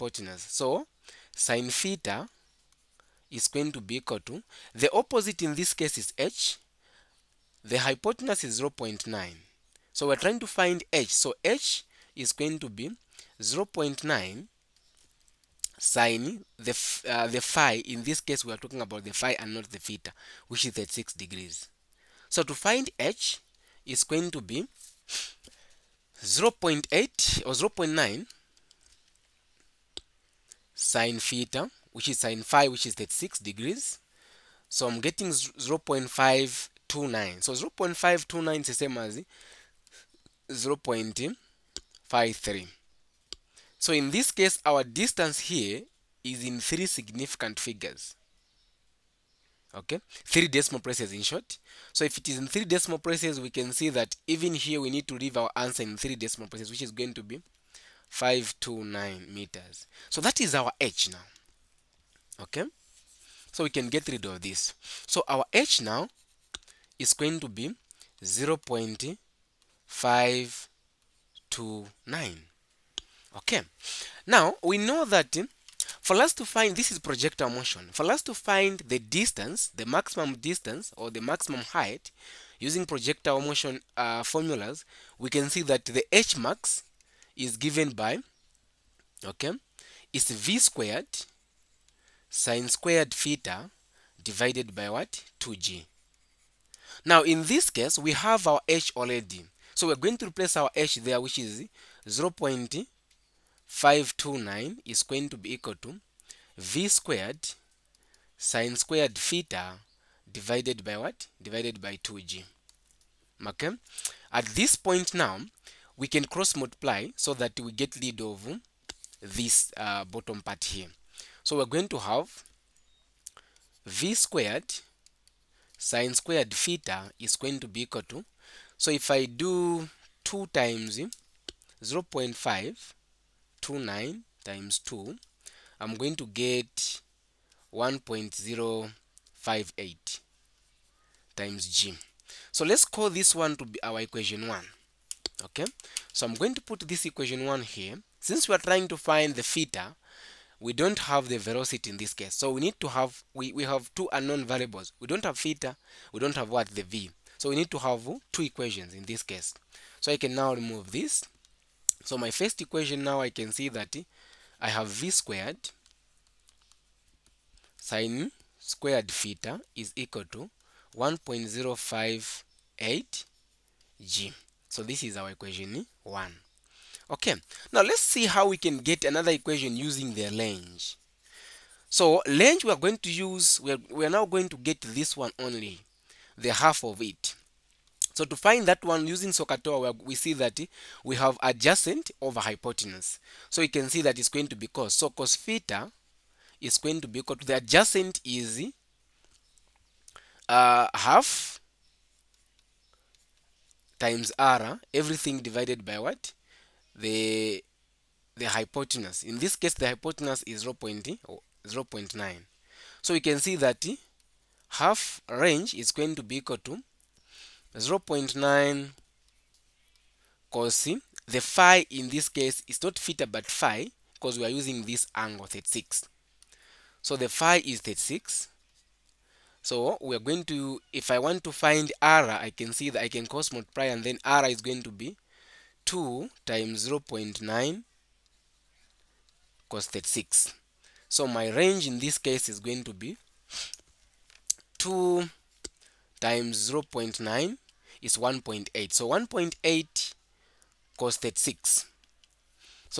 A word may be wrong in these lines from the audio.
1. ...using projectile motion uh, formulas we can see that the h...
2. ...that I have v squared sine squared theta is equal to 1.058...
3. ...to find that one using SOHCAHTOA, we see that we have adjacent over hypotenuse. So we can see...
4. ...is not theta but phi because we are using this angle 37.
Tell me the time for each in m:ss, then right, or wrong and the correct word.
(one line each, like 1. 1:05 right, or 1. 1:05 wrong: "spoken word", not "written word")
1. 1:22 right
2. 2:43 right
3. 3:08 right
4. 3:42 wrong: "36", not "37".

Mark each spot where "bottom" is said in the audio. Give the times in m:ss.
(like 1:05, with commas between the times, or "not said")
2:00.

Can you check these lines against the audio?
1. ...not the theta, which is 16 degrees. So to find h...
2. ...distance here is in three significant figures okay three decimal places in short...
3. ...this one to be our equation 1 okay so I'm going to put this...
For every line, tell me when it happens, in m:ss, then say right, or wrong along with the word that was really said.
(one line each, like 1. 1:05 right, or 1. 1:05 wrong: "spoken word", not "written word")
1. 0:19 wrong: "36", not "16"
2. 0:44 right
3. 2:23 right.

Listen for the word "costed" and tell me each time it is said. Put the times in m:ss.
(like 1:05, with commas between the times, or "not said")
3:59, 4:10.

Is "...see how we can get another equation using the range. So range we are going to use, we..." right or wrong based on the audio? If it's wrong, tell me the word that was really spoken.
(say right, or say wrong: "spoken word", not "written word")
right.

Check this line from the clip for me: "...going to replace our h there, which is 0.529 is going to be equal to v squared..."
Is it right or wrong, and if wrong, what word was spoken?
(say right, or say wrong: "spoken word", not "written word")
right.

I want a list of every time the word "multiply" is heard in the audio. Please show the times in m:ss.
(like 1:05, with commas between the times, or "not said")
1:56, 3:53.